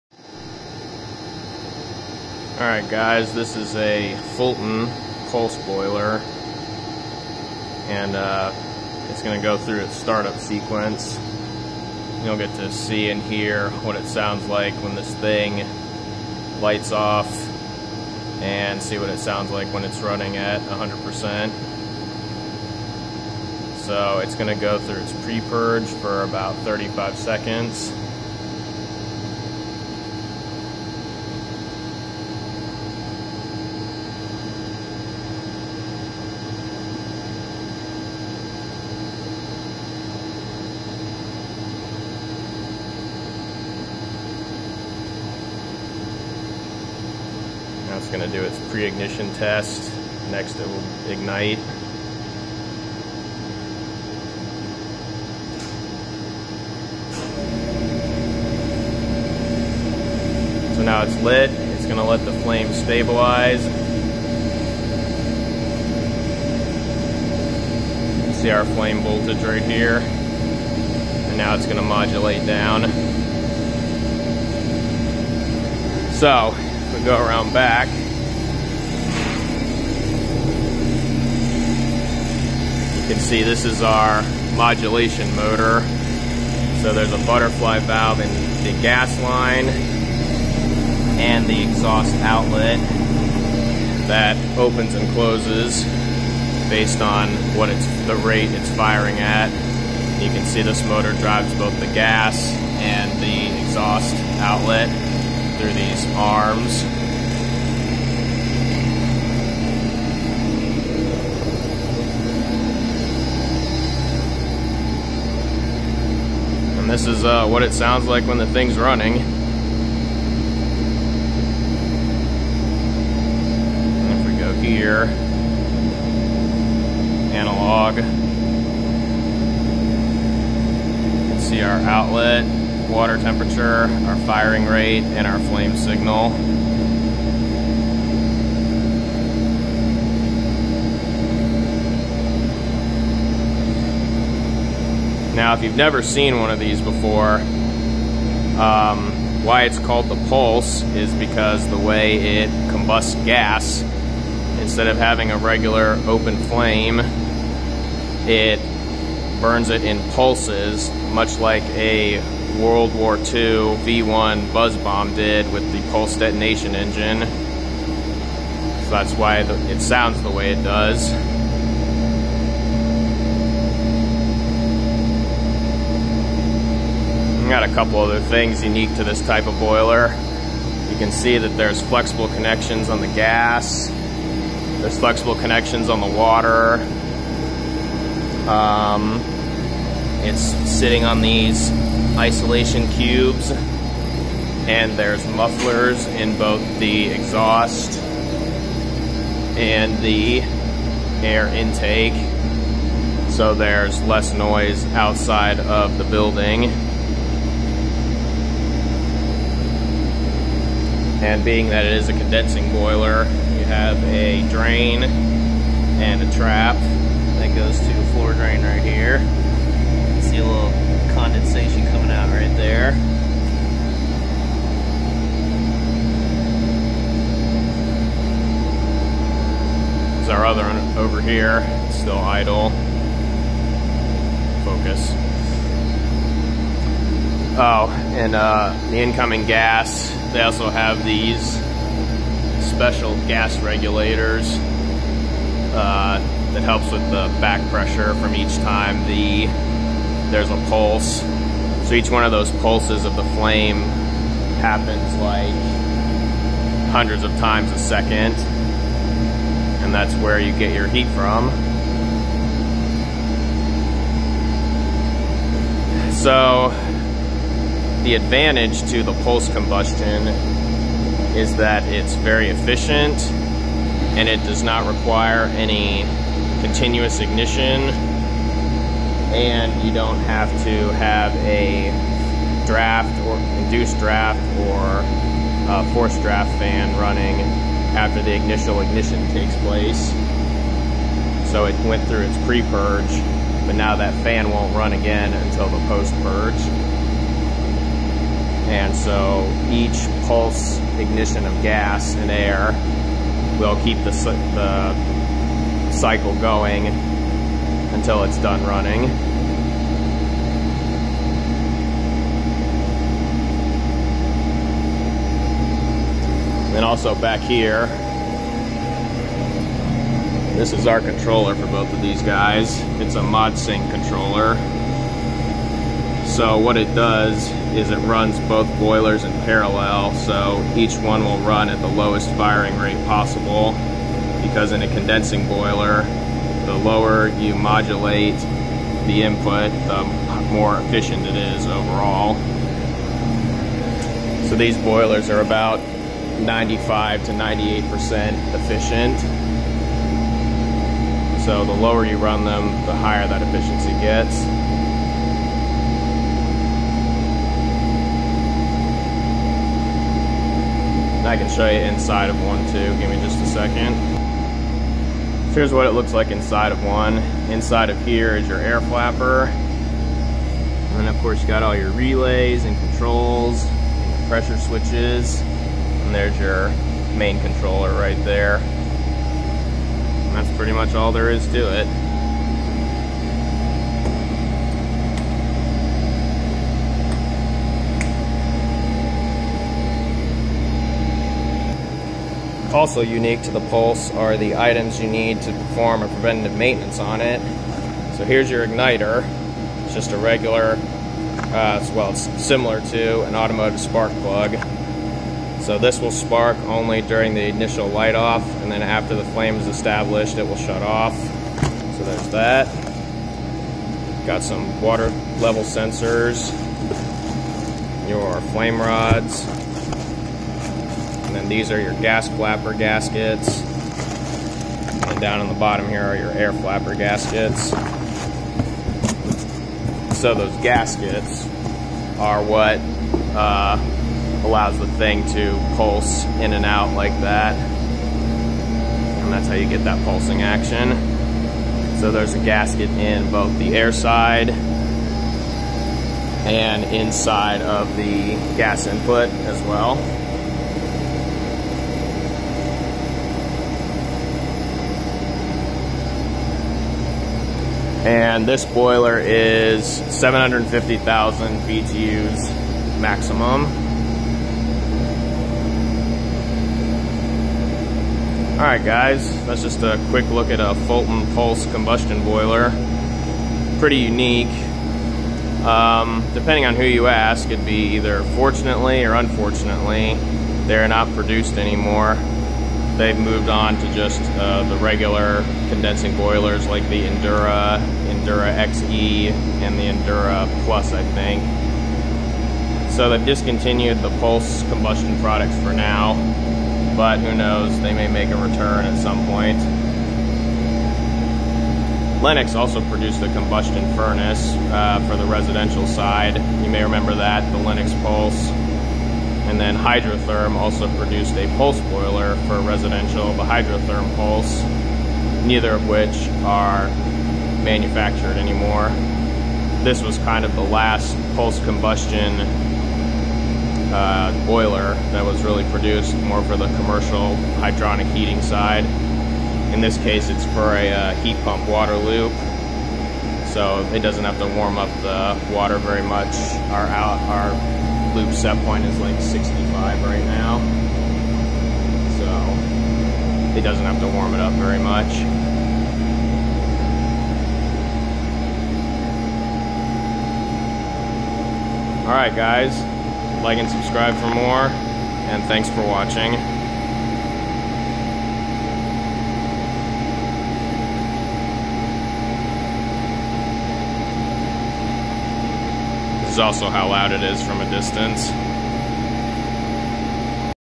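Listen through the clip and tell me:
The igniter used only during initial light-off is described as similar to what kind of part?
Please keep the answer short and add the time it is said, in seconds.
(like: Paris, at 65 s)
automotive spark plug, at 403 s.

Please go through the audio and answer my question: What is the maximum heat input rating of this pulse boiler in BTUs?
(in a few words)
750,000.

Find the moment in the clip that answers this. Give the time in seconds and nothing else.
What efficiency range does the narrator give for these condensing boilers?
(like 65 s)
346 s.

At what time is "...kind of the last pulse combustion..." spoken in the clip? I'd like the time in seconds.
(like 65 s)
520 s.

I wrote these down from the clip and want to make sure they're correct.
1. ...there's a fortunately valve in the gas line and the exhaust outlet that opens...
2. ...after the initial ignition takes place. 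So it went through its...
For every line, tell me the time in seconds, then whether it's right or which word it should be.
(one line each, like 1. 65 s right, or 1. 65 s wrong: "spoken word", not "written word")
1. 86 s wrong: "butterfly", not "fortunately"
2. 287 s right.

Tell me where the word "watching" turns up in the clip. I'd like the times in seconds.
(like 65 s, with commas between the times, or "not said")
555 s.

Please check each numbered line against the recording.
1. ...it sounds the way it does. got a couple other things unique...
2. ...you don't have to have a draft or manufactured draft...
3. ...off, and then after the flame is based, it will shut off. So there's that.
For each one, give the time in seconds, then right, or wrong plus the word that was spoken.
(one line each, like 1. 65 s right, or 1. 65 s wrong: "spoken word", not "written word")
1. 169 s right
2. 279 s wrong: "induced", not "manufactured"
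3. 408 s wrong: "established", not "based".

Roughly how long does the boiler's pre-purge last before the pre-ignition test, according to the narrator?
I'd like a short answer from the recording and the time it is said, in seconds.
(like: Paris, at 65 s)
35 seconds, at 26 s.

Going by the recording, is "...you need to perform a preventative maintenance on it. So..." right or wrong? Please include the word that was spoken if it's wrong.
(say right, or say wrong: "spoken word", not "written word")
right.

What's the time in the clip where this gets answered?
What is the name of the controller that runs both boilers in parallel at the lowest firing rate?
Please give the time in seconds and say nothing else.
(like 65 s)
323 s.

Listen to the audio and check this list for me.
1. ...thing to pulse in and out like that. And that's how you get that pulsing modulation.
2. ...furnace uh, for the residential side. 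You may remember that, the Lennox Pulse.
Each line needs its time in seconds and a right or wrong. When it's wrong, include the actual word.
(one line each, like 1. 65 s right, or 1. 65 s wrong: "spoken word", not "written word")
1. 434 s wrong: "action", not "modulation"
2. 503 s right.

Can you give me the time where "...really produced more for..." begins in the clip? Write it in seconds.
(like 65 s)
525 s.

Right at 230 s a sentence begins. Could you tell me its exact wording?
There's our other one over here, it's still idle.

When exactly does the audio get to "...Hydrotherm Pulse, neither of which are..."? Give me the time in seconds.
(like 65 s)
513 s.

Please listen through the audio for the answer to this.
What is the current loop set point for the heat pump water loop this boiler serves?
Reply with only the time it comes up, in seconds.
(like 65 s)
539 s.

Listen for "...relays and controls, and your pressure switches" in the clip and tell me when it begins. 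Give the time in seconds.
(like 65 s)
371 s.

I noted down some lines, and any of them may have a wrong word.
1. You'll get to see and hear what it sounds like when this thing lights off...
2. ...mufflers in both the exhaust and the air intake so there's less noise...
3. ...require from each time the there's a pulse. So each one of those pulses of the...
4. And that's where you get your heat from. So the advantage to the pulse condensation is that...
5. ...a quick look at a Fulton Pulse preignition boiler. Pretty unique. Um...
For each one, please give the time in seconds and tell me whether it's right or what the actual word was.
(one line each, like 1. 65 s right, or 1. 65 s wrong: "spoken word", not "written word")
1. 12 s right
2. 195 s right
3. 247 s wrong: "pressure", not "require"
4. 259 s wrong: "combustion", not "condensation"
5. 469 s wrong: "combustion", not "preignition".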